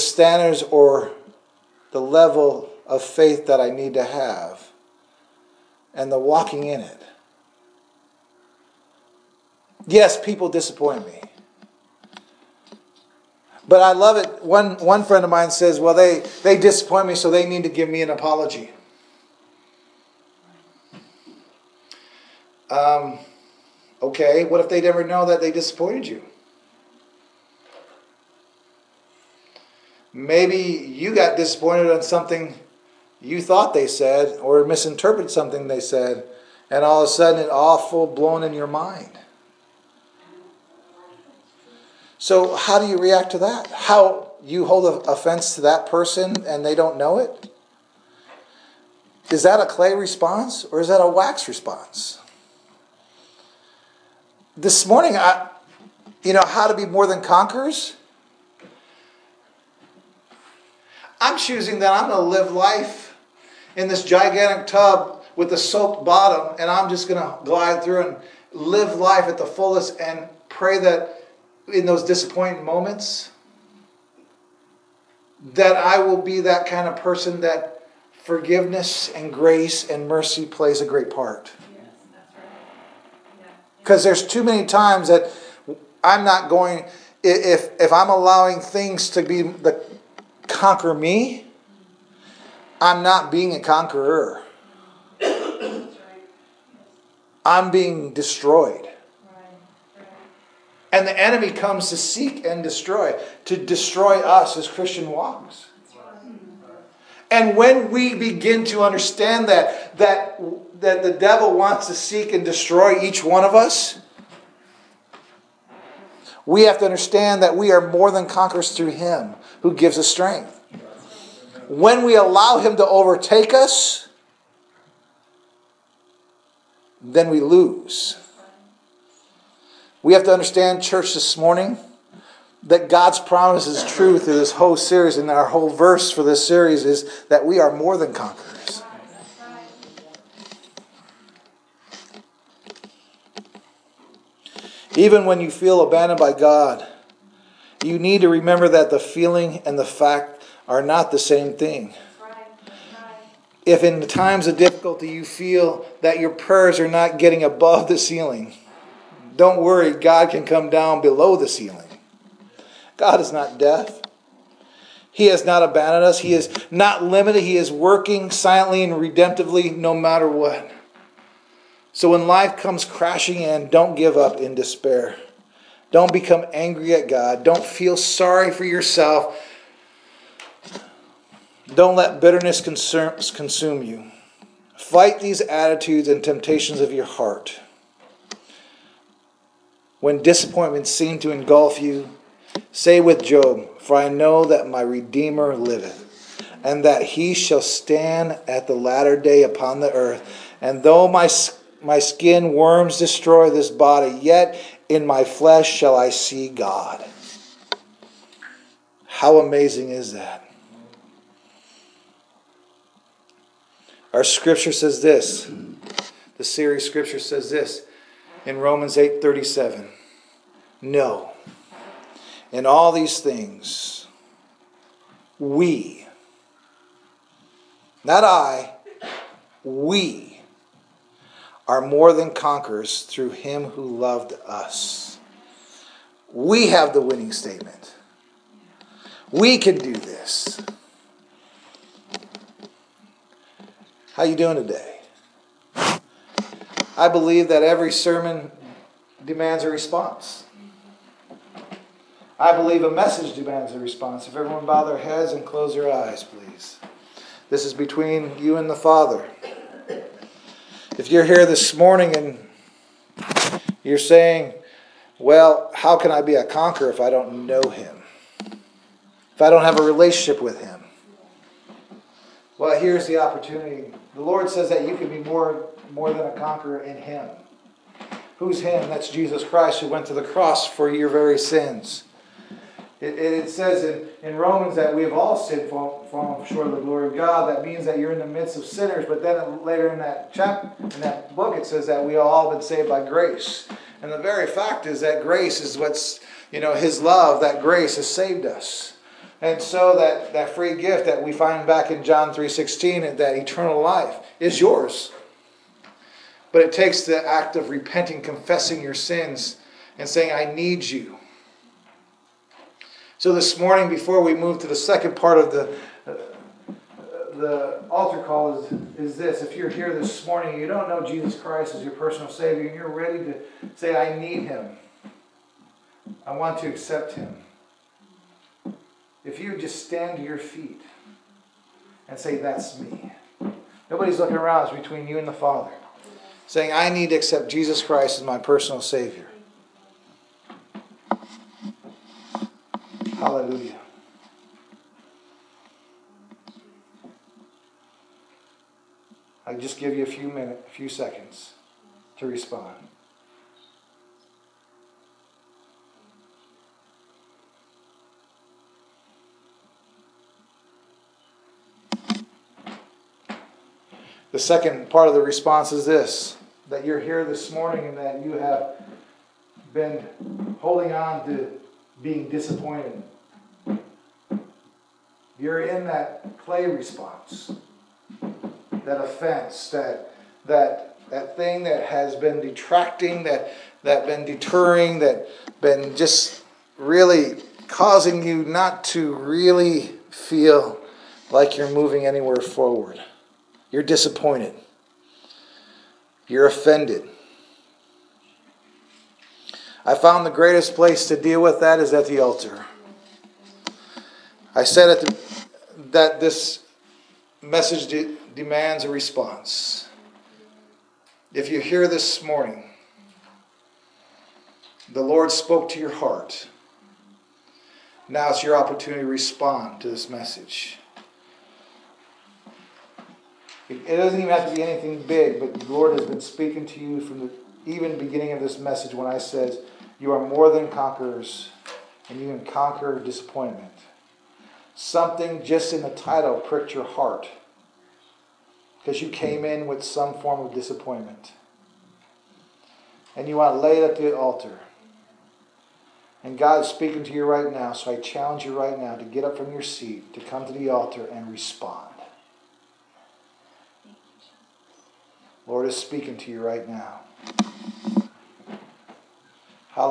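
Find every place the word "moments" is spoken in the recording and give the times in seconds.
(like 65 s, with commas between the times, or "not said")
72 s.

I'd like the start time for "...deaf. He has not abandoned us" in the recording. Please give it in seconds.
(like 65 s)
163 s.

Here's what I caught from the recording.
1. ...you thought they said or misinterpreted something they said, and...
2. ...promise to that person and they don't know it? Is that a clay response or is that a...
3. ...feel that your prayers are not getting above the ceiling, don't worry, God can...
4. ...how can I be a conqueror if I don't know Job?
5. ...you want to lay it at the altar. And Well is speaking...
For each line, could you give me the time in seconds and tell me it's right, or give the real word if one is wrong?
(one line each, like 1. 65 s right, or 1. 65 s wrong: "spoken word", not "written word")
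1. 33 s right
2. 45 s wrong: "offense", not "promise"
3. 155 s right
4. 265 s wrong: "Him", not "Job"
5. 443 s wrong: "God", not "Well".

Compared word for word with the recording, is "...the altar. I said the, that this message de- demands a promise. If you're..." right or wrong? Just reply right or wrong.
wrong.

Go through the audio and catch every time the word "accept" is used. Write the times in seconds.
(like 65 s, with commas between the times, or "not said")
326 s, 337 s.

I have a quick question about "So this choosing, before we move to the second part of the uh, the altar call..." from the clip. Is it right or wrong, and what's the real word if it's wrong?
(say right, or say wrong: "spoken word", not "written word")
wrong: "morning", not "choosing".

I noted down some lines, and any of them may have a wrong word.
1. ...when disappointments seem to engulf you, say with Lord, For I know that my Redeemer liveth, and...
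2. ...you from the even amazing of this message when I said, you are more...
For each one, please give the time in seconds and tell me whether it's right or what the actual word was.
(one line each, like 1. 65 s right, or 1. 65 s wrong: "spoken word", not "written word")
1. 190 s wrong: "Job", not "Lord"
2. 426 s wrong: "beginning", not "amazing".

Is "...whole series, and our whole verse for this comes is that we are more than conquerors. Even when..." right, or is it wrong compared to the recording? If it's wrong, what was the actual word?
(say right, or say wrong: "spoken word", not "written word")
wrong: "series", not "comes".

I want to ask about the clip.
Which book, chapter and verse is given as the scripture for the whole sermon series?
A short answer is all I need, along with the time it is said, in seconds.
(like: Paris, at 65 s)
Romans 8:37, at 218 s.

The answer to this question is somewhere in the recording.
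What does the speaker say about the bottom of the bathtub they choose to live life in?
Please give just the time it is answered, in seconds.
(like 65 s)
65 s.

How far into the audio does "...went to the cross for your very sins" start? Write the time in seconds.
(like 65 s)
279 s.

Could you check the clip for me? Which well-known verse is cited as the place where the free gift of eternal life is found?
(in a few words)
John 3:16.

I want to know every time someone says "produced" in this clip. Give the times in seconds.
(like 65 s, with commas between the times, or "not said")
not said.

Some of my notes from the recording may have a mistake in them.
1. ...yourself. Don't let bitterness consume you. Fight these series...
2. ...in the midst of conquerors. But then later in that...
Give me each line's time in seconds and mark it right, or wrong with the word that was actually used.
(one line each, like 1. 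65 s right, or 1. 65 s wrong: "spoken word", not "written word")
1. 178 s wrong: "attitudes", not "series"
2. 288 s wrong: "sinners", not "conquerors".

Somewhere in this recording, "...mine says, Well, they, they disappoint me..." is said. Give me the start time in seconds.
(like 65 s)
15 s.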